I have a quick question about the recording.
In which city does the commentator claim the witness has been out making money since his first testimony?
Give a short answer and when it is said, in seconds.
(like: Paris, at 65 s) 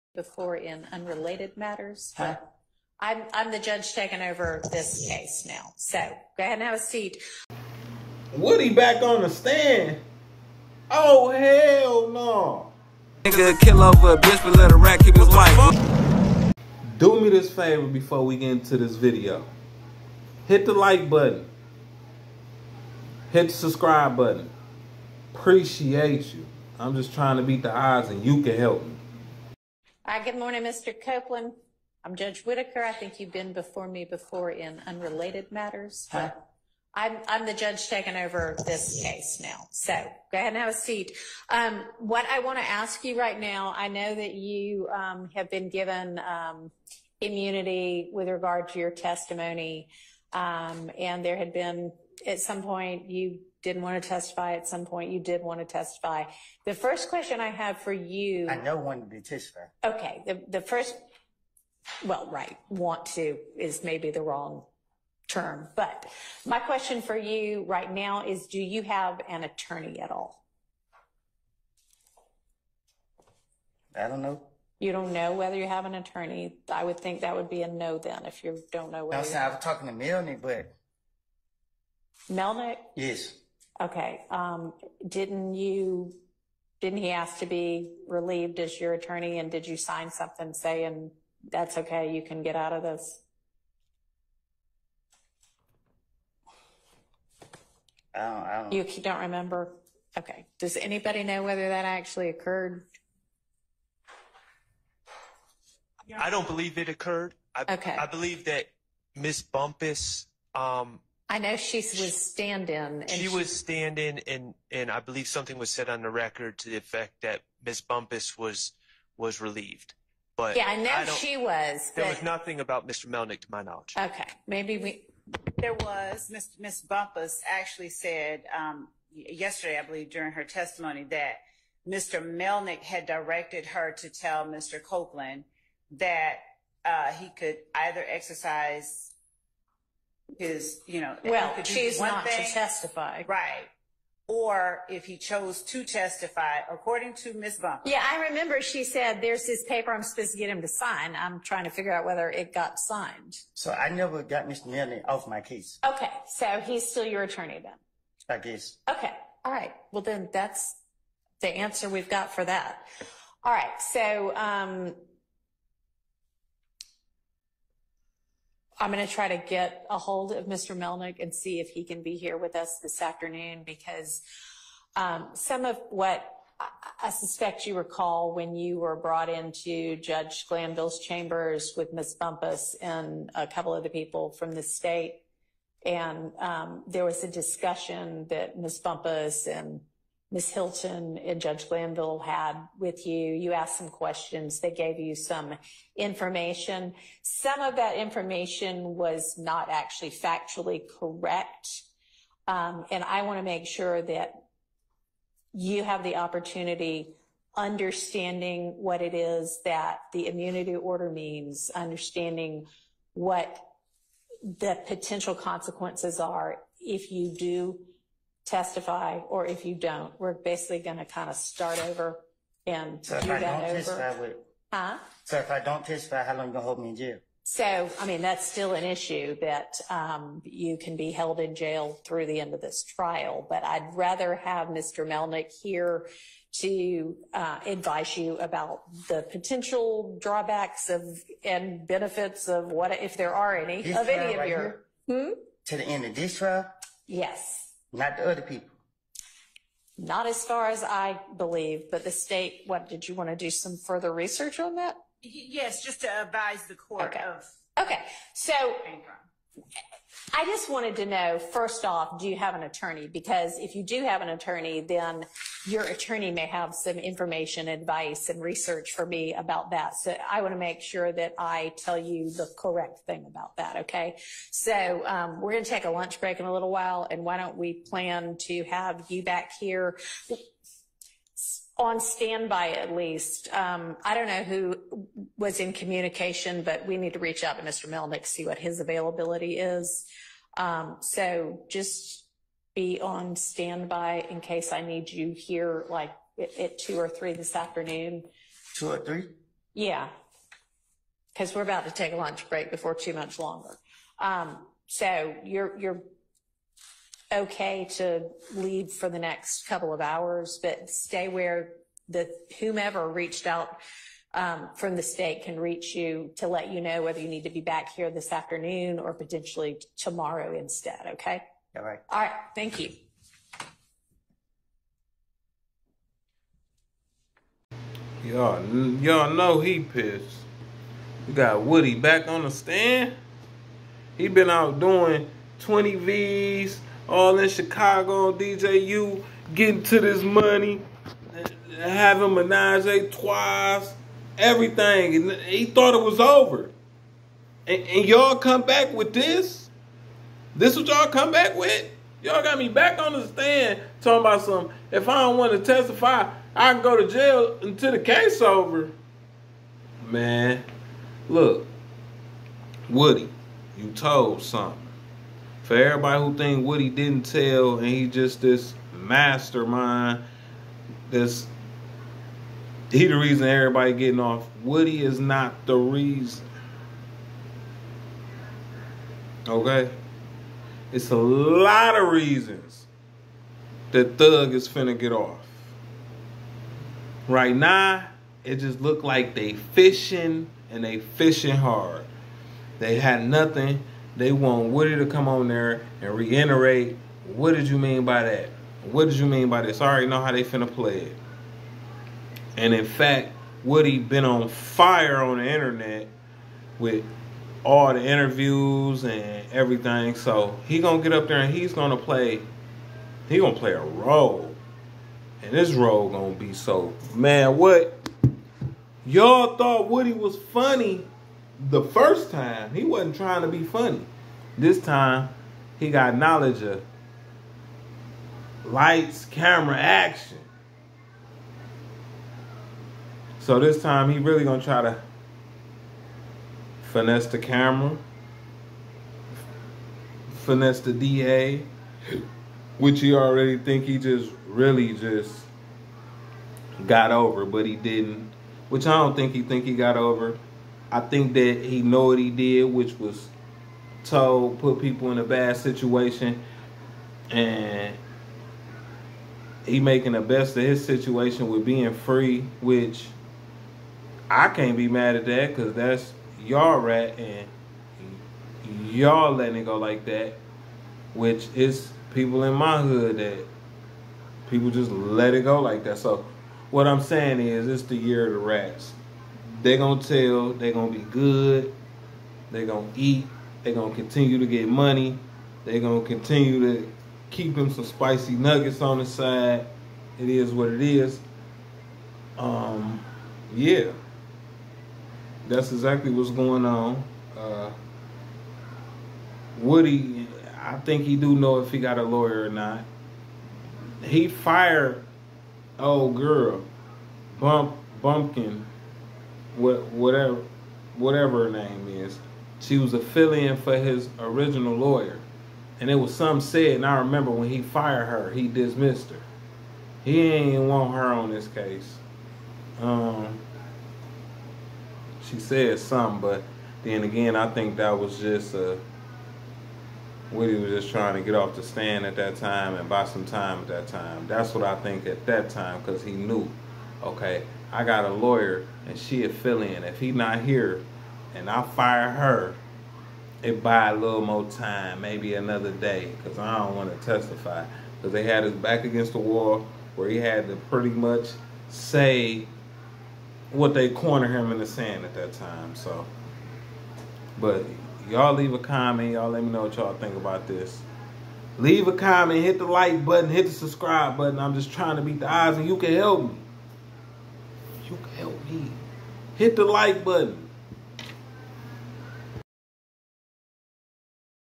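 Chicago, at 337 s.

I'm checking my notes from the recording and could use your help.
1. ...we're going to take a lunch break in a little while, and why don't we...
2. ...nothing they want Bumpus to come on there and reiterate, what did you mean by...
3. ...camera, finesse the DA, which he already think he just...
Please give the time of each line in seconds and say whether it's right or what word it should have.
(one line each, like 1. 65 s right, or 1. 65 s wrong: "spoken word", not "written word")
1. 275 s right
2. 393 s wrong: "Woody", not "Bumpus"
3. 437 s right.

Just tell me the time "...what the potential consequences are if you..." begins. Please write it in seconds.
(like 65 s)
213 s.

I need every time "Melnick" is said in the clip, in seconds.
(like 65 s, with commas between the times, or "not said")
82 s, 123 s, 132 s, 170 s, 235 s, 287 s.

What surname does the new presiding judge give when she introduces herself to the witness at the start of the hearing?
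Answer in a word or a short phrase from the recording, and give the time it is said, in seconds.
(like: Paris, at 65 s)
Whitaker, at 32 s.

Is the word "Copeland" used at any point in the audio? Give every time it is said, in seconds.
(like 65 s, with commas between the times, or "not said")
31 s, 134 s.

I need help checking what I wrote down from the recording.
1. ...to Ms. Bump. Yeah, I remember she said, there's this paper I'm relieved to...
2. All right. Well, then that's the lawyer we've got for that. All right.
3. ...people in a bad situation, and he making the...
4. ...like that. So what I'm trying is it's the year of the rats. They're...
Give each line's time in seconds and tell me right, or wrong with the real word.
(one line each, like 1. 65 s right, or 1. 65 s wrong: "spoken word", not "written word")
1. 147 s wrong: "supposed", not "relieved"
2. 159 s wrong: "answer", not "lawyer"
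3. 454 s right
4. 475 s wrong: "saying", not "trying".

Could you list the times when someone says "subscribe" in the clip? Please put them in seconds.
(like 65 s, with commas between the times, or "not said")
23 s, 563 s.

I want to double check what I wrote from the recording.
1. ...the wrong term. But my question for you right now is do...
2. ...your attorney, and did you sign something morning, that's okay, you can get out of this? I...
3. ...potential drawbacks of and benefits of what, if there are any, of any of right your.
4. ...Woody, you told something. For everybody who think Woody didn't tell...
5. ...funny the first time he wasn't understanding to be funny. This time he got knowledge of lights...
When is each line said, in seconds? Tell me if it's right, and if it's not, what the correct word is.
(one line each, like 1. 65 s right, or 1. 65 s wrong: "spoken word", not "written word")
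1. 64 s right
2. 88 s wrong: "saying", not "morning"
3. 239 s right
4. 362 s right
5. 420 s wrong: "trying", not "understanding".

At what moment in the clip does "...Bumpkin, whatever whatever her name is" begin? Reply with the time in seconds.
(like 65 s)
508 s.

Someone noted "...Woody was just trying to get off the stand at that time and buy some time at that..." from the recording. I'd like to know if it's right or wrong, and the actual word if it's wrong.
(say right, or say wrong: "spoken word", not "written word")
right.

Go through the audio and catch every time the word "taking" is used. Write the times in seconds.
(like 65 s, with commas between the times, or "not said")
3 s, 37 s.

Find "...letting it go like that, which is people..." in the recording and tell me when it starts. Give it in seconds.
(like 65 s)
469 s.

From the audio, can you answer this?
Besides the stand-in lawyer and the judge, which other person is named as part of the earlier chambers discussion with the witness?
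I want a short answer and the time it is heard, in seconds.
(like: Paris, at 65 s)
Ms. Hilton, at 190 s.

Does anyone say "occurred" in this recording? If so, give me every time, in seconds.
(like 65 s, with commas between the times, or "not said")
102 s, 106 s.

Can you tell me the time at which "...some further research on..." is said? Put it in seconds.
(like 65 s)
253 s.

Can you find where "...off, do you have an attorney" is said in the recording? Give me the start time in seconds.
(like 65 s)
261 s.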